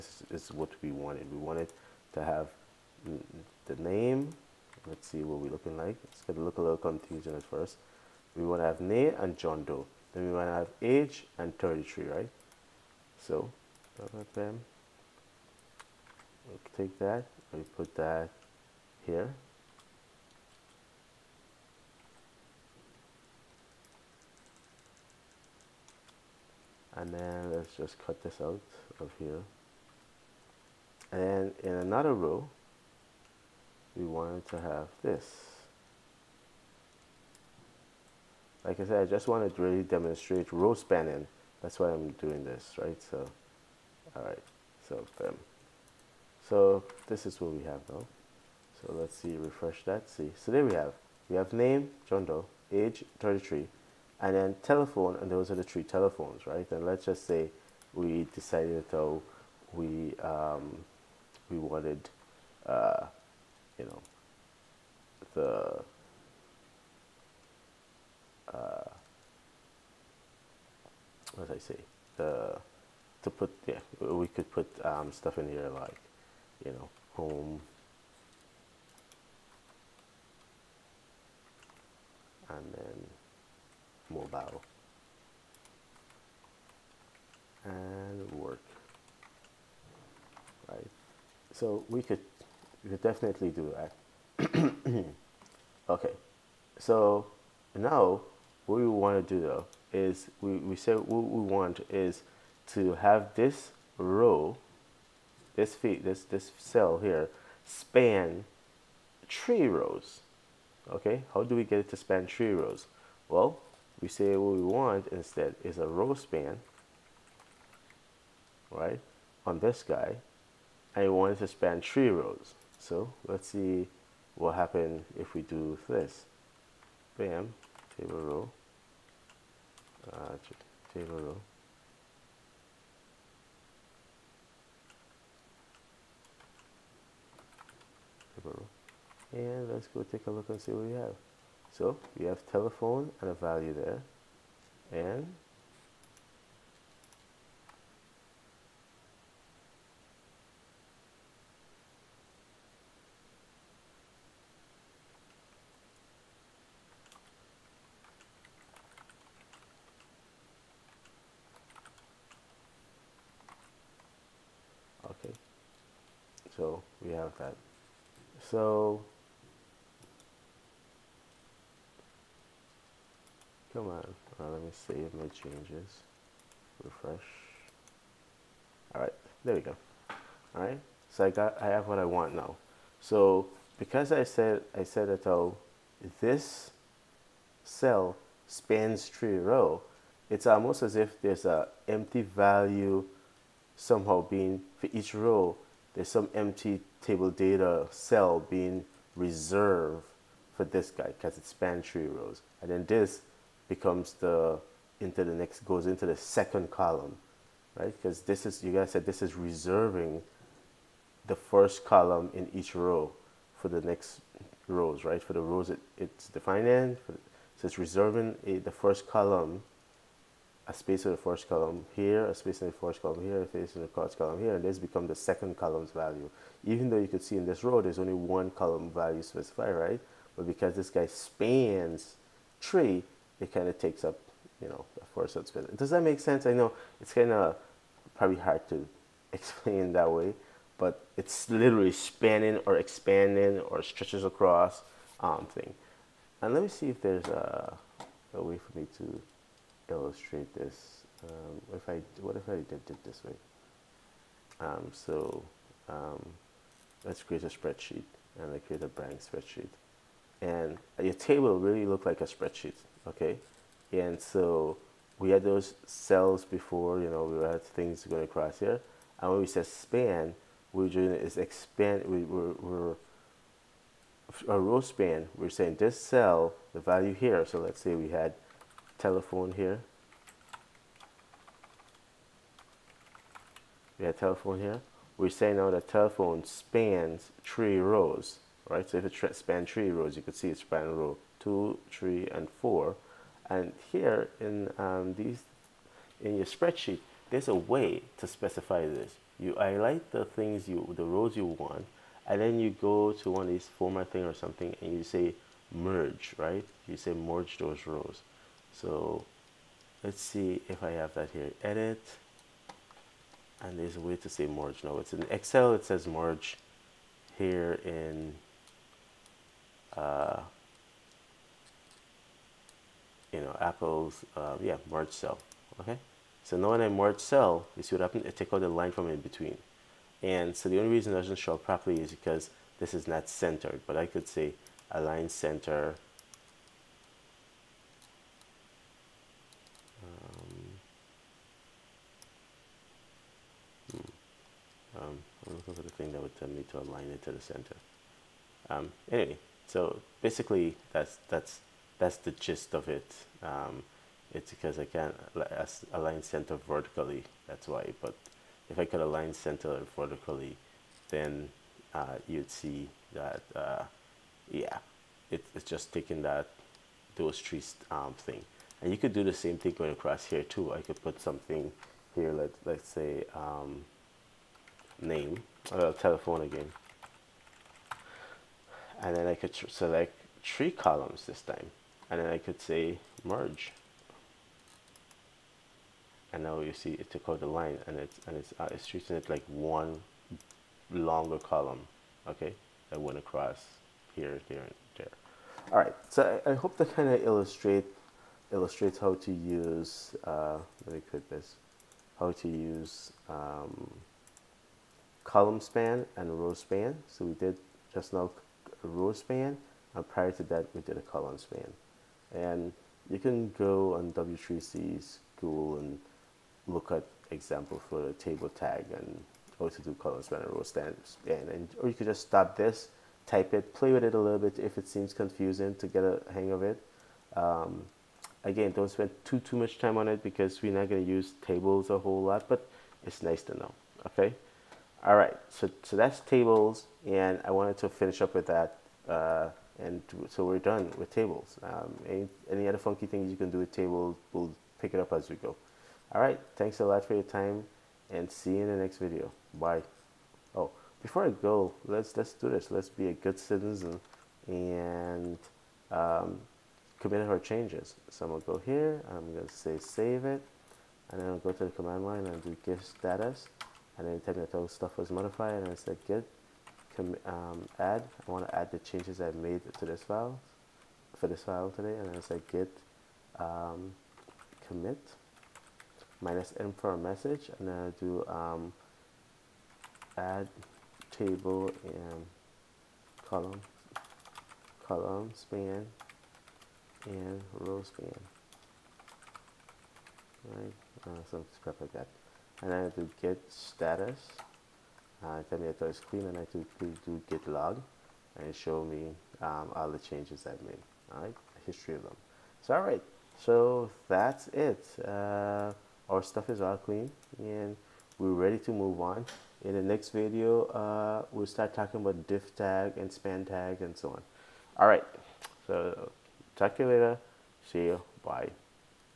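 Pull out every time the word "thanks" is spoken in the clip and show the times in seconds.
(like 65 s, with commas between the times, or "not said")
446 s.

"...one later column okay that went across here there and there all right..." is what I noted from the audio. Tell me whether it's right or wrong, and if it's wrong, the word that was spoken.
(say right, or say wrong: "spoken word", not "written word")
wrong: "longer", not "later".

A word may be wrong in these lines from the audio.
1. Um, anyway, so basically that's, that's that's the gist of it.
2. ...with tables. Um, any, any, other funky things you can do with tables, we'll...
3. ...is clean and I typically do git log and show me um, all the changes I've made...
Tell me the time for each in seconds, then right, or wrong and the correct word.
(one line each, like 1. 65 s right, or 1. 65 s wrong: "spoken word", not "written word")
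1. 348 s right
2. 440 s right
3. 495 s right.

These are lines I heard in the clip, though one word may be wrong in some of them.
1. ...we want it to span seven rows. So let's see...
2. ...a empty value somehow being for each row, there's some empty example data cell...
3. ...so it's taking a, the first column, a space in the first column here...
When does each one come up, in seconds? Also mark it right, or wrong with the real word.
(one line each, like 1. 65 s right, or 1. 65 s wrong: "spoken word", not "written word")
1. 121 s wrong: "three", not "seven"
2. 191 s wrong: "table", not "example"
3. 217 s wrong: "reserving", not "taking".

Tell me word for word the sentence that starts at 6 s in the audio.
It's going to look a little confusing at first.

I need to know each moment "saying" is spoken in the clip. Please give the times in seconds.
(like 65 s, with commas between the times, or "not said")
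275 s, 285 s.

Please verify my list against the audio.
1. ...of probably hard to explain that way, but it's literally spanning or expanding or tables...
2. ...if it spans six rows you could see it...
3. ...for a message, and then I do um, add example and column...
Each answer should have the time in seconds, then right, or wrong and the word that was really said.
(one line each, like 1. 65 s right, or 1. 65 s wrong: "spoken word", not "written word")
1. 237 s wrong: "stretches", not "tables"
2. 288 s wrong: "three", not "six"
3. 476 s wrong: "table", not "example".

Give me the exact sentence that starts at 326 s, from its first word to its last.
So now when I merge cell, you see what happened?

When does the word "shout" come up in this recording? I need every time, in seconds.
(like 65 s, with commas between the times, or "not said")
not said.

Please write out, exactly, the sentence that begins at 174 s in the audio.
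Right, let me save my changes.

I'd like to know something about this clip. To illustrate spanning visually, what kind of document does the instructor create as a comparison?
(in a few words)
blank spreadsheet.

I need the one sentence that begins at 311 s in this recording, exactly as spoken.
Edit, and there's a way to say merge.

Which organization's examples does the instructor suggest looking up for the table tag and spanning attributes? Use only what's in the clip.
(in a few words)
W3C.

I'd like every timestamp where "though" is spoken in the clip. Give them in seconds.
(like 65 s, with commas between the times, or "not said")
58 s, 99 s, 226 s.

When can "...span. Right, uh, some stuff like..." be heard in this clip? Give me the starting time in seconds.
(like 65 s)
487 s.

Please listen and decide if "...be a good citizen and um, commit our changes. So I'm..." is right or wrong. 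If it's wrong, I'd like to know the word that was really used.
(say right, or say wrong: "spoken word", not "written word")
right.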